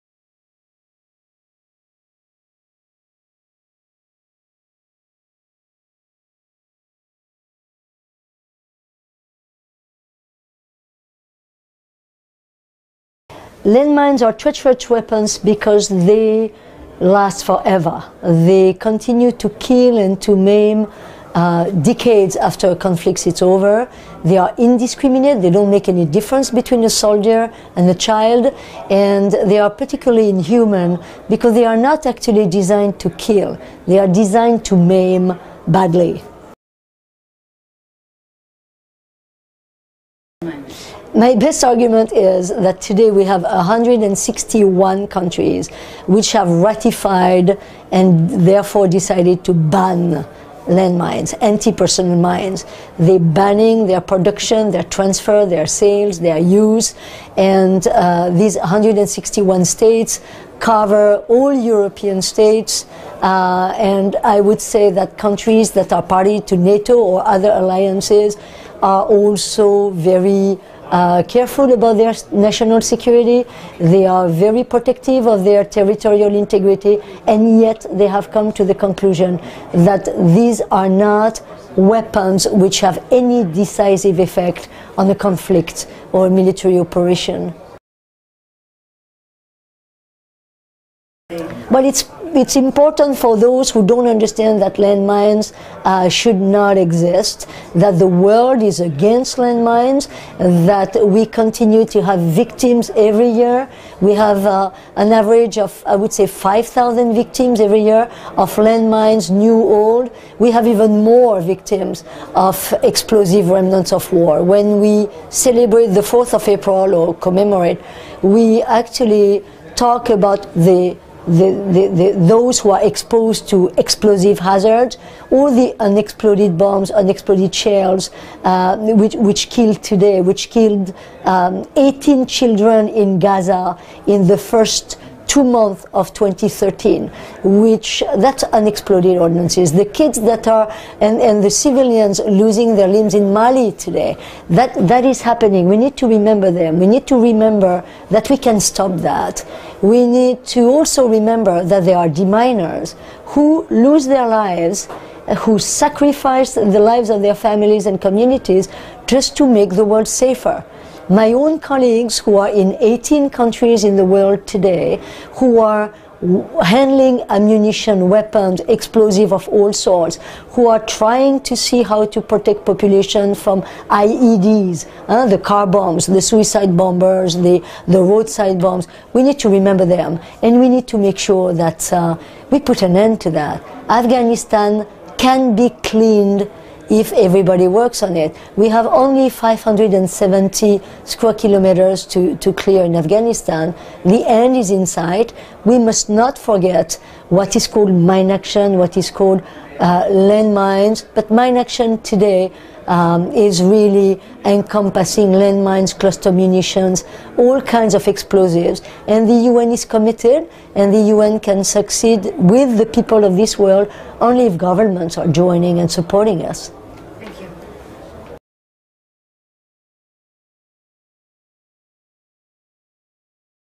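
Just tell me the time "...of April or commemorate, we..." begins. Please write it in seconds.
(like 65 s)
116 s.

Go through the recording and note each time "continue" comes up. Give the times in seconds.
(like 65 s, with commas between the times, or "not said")
18 s, 101 s.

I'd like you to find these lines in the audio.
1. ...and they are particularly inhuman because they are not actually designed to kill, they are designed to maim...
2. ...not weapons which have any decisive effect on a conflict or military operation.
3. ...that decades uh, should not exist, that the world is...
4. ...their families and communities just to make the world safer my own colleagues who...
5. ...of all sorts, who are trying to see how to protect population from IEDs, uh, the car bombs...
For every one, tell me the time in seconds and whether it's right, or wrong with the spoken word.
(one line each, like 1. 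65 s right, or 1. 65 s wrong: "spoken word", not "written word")
1. 28 s right
2. 80 s right
3. 94 s wrong: "landmines", not "decades"
4. 157 s right
5. 169 s right.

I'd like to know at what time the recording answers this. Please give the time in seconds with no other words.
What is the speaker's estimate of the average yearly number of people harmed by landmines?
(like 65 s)
106 s.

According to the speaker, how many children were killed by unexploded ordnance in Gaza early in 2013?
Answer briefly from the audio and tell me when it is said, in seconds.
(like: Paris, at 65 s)
18, at 131 s.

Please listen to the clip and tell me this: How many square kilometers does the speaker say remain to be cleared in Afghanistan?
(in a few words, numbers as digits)
570.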